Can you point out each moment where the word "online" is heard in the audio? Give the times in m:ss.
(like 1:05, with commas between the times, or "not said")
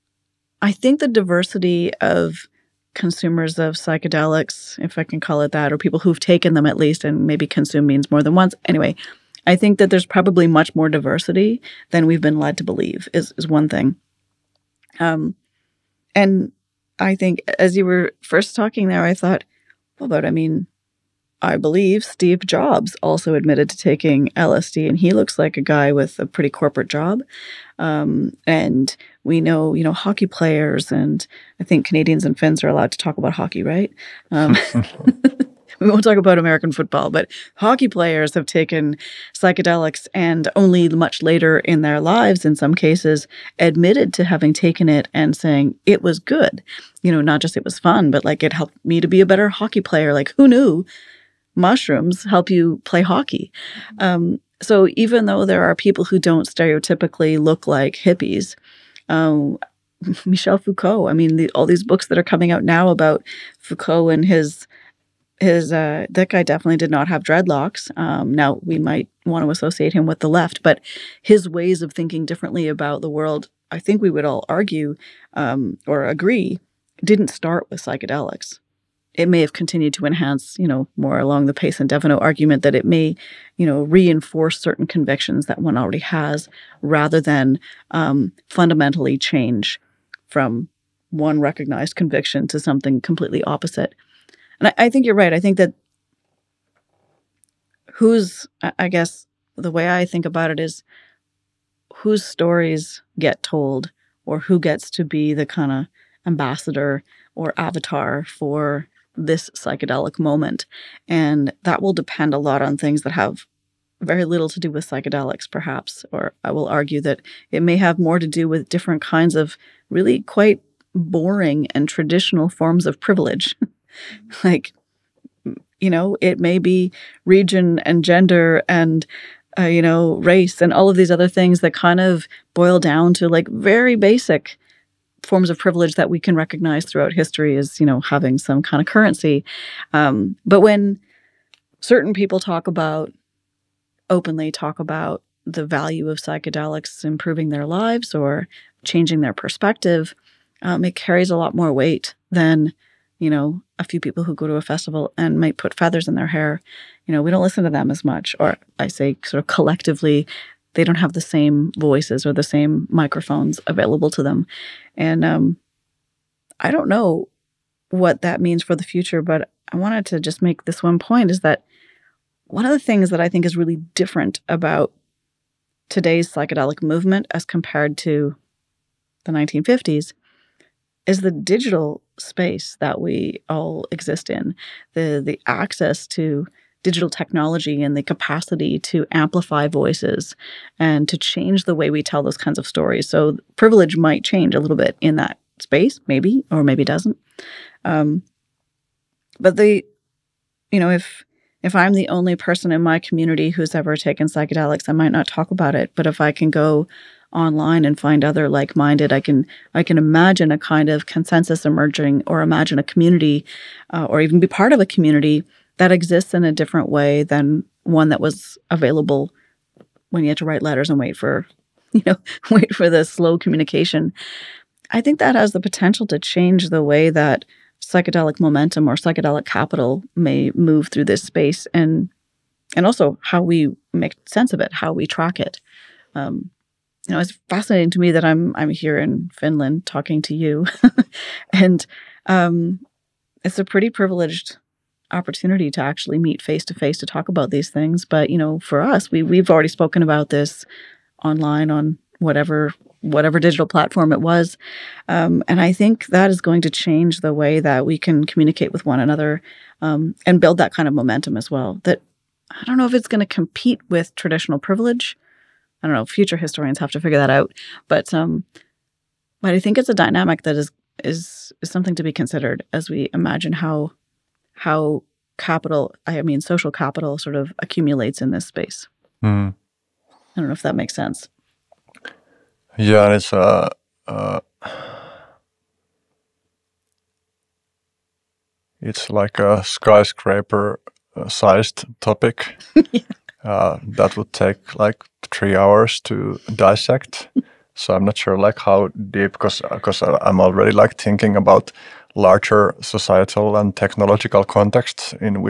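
3:27, 4:11.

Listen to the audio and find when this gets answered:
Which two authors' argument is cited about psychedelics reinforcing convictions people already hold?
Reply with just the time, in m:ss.
1:21.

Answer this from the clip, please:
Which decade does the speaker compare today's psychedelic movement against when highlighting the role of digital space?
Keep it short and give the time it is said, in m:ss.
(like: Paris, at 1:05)
1950s, at 2:59.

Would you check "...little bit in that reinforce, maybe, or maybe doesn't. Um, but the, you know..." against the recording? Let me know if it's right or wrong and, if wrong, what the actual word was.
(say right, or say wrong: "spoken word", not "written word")
wrong: "space", not "reinforce".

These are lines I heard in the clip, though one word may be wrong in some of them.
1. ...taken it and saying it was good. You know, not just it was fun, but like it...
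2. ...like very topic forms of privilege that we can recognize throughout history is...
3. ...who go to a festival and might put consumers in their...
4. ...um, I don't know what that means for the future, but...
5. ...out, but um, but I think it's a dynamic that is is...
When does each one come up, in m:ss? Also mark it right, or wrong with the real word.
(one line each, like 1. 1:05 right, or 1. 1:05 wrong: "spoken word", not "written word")
1. 0:44 right
2. 2:13 wrong: "basic", not "topic"
3. 2:34 wrong: "feathers", not "consumers"
4. 2:45 right
5. 4:27 right.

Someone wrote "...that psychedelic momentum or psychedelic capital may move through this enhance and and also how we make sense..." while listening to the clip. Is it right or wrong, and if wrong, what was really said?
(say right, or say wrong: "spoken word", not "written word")
wrong: "space", not "enhance".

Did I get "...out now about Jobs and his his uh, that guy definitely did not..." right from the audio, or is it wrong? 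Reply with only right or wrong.
wrong.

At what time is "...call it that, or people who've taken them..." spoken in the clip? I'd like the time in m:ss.
0:05.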